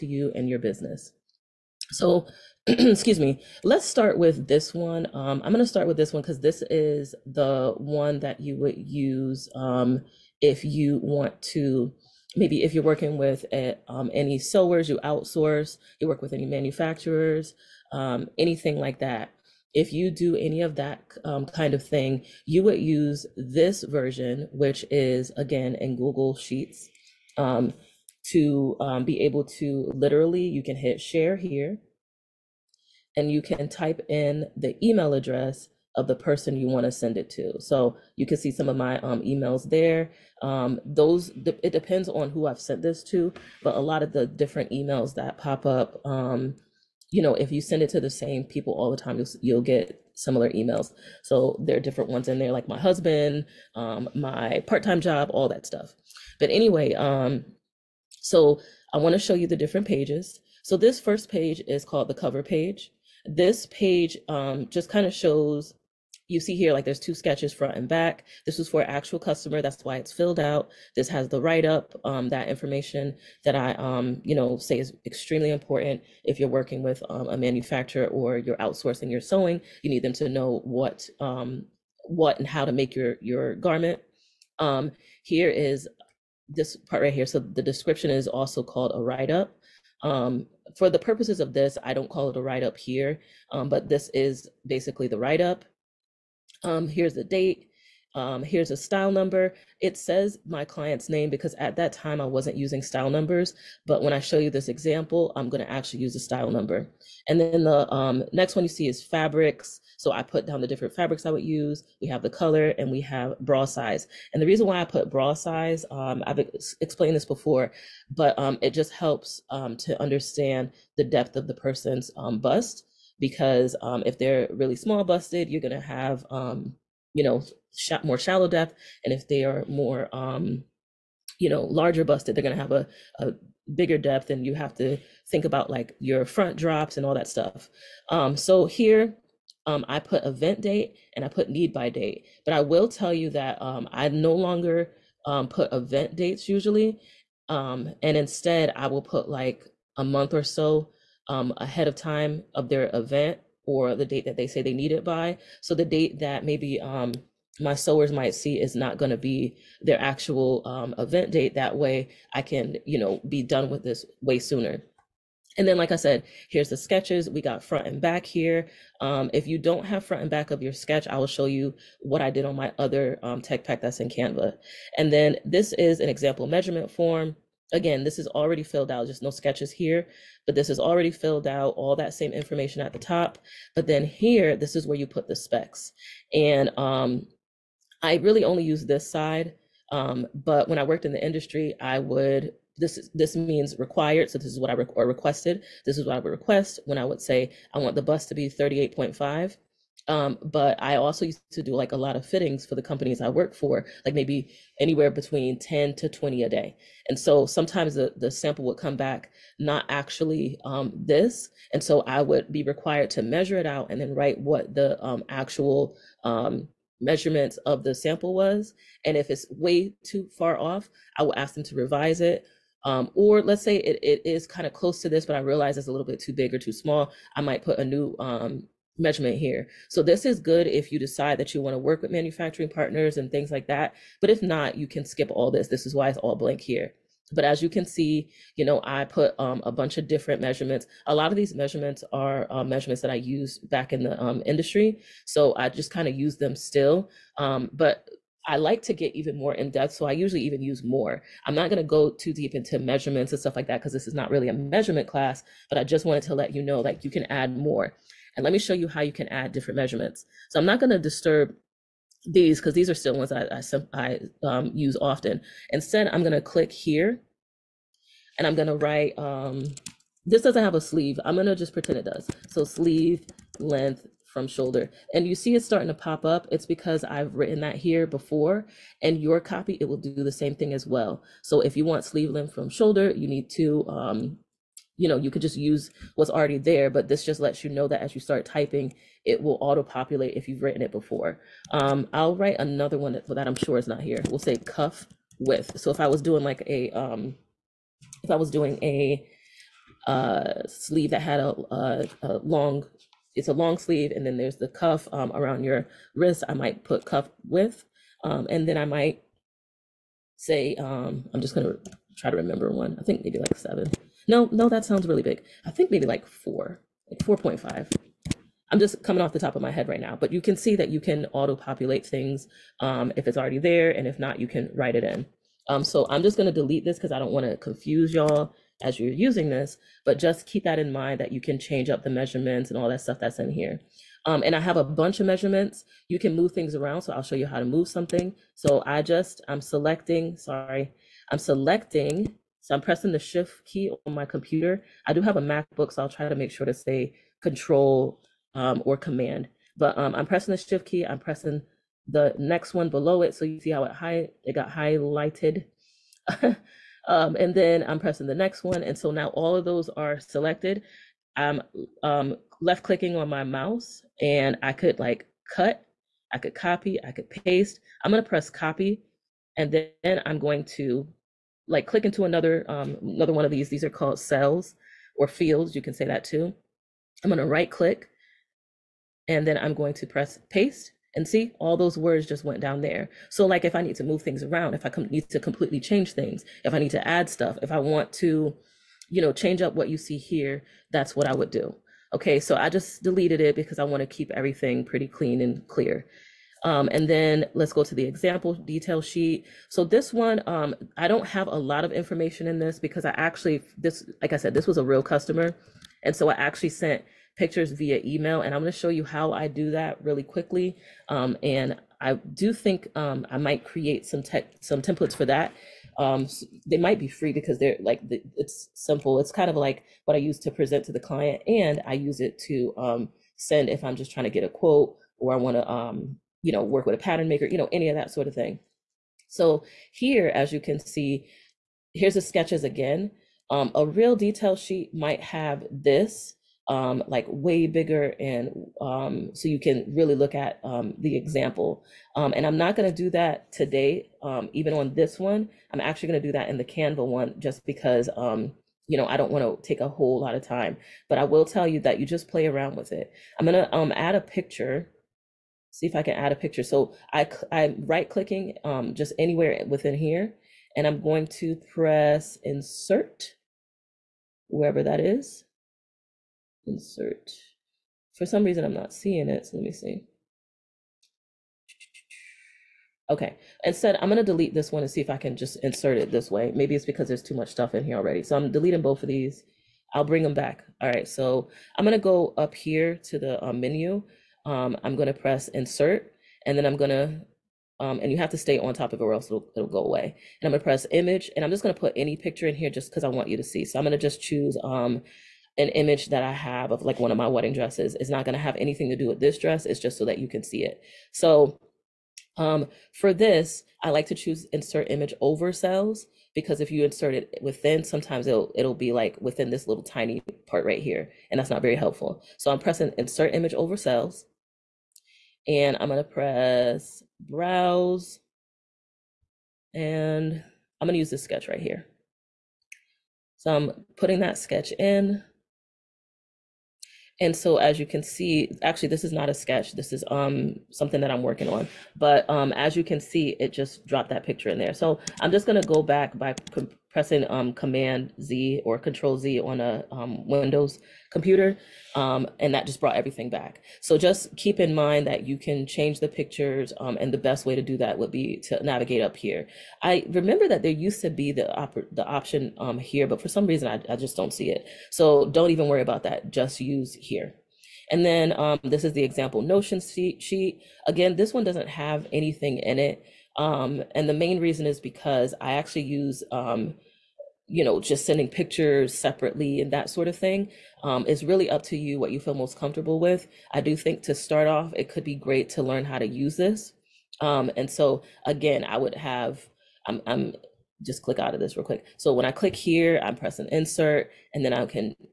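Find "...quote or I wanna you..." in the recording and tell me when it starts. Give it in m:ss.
7:04.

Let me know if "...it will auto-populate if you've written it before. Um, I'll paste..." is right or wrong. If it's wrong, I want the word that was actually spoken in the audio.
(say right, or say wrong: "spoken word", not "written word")
wrong: "write", not "paste".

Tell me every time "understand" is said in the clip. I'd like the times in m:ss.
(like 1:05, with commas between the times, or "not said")
2:00.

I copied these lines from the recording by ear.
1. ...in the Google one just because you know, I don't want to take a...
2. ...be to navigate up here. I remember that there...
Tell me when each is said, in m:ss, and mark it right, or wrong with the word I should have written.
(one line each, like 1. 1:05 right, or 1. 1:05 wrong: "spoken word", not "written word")
1. 7:26 wrong: "Canva", not "Google"
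2. 9:08 right.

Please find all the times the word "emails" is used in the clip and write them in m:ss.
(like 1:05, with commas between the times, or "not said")
0:34, 0:39, 0:44, 0:50, 6:48.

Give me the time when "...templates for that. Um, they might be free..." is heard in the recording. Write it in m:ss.
6:54.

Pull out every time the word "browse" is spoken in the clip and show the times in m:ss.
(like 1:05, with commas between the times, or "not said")
8:37.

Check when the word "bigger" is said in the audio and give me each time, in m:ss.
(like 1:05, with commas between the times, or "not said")
2:13, 7:17.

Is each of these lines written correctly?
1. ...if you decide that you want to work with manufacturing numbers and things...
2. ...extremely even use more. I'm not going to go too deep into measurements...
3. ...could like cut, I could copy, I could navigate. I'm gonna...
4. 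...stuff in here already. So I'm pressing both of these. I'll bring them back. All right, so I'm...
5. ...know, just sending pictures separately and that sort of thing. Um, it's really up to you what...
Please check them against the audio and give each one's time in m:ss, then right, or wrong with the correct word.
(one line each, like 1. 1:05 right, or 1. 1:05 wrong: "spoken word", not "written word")
1. 3:50 wrong: "partners", not "numbers"
2. 4:10 wrong: "usually", not "extremely"
3. 6:04 wrong: "paste", not "navigate"
4. 7:57 wrong: "deleting", not "pressing"
5. 9:27 right.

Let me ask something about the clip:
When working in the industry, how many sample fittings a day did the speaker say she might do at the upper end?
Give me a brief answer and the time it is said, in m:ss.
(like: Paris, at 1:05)
20, at 3:26.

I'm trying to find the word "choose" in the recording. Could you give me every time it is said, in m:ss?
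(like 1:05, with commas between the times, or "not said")
8:14, 8:24.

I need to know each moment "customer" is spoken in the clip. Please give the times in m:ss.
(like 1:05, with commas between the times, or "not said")
1:09, 6:45.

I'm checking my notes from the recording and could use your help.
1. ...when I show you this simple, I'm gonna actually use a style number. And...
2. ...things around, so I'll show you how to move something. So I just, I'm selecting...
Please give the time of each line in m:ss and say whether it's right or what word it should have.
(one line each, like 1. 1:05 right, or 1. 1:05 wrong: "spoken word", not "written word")
1. 1:44 wrong: "example", not "simple"
2. 5:36 right.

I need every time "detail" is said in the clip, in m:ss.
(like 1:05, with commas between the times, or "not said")
6:38, 7:14.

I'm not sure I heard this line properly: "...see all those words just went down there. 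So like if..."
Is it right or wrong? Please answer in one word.
right.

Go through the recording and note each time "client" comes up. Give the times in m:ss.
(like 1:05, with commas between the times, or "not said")
1:40, 7:00.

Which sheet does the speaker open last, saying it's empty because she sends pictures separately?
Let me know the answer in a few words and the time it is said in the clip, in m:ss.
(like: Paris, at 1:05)
example notion sheet, at 9:19.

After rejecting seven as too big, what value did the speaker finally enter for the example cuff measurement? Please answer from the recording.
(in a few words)
4.5.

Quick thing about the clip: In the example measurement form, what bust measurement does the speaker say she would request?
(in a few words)
38.5.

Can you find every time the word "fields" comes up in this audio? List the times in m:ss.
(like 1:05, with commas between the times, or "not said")
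6:15.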